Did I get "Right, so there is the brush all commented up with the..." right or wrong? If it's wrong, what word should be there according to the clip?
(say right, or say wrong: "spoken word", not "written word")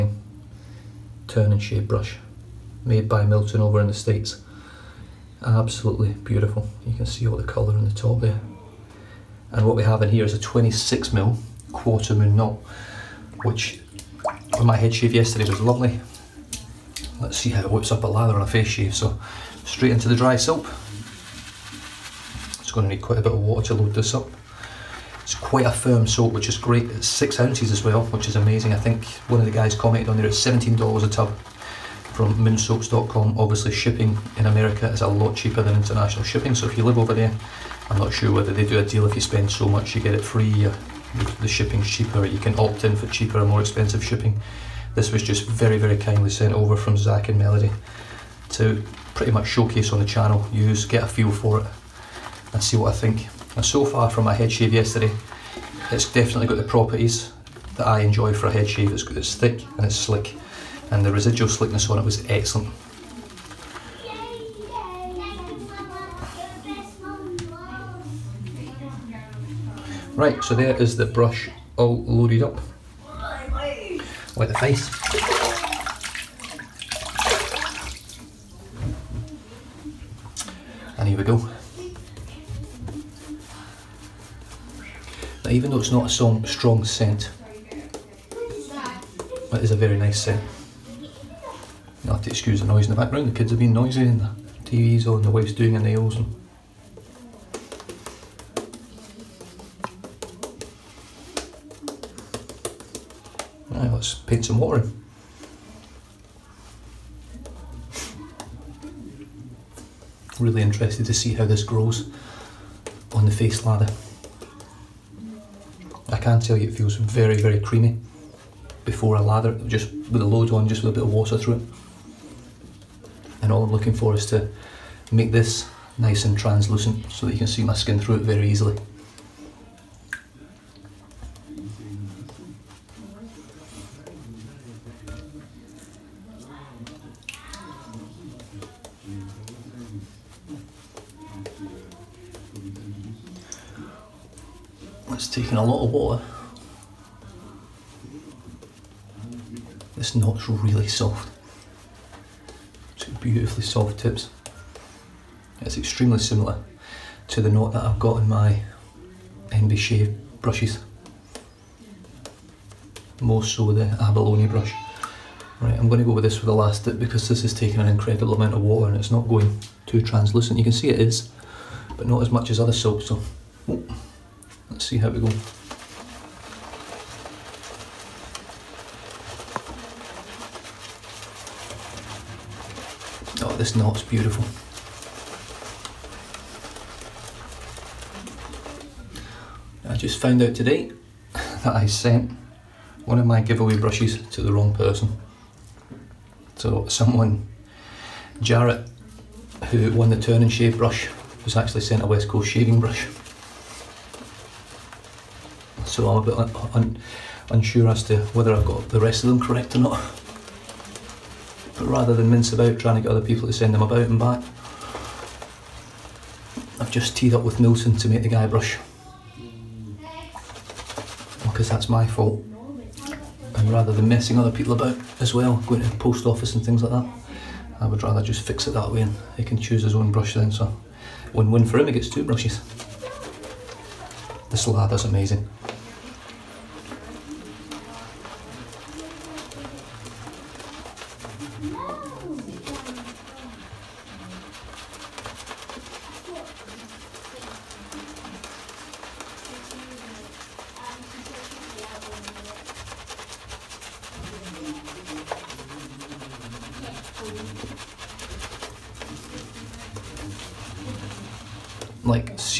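wrong: "loaded", not "commented".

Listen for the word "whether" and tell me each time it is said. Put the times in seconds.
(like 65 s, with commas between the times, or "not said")
38 s, 208 s.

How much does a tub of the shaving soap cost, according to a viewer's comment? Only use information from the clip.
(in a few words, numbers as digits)
$17.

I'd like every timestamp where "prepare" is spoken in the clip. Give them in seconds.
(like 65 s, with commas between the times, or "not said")
not said.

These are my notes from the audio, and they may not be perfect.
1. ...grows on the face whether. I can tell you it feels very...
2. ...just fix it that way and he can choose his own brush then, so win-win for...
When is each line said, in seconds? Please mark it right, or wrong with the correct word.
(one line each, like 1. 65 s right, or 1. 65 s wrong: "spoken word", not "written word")
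1. 111 s wrong: "lather", not "whether"
2. 228 s right.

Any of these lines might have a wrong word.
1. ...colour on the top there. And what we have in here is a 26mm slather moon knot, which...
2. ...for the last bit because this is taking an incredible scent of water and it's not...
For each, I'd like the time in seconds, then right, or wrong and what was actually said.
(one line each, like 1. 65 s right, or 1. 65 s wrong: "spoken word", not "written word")
1. 7 s wrong: "quarter", not "slather"
2. 166 s wrong: "amount", not "scent".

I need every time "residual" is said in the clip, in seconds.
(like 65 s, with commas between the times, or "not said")
61 s.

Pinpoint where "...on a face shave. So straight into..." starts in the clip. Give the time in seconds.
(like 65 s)
18 s.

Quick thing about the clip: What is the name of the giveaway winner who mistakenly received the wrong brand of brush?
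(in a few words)
Jarrett.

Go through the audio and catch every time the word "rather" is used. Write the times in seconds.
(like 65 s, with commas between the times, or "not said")
211 s, 223 s, 228 s.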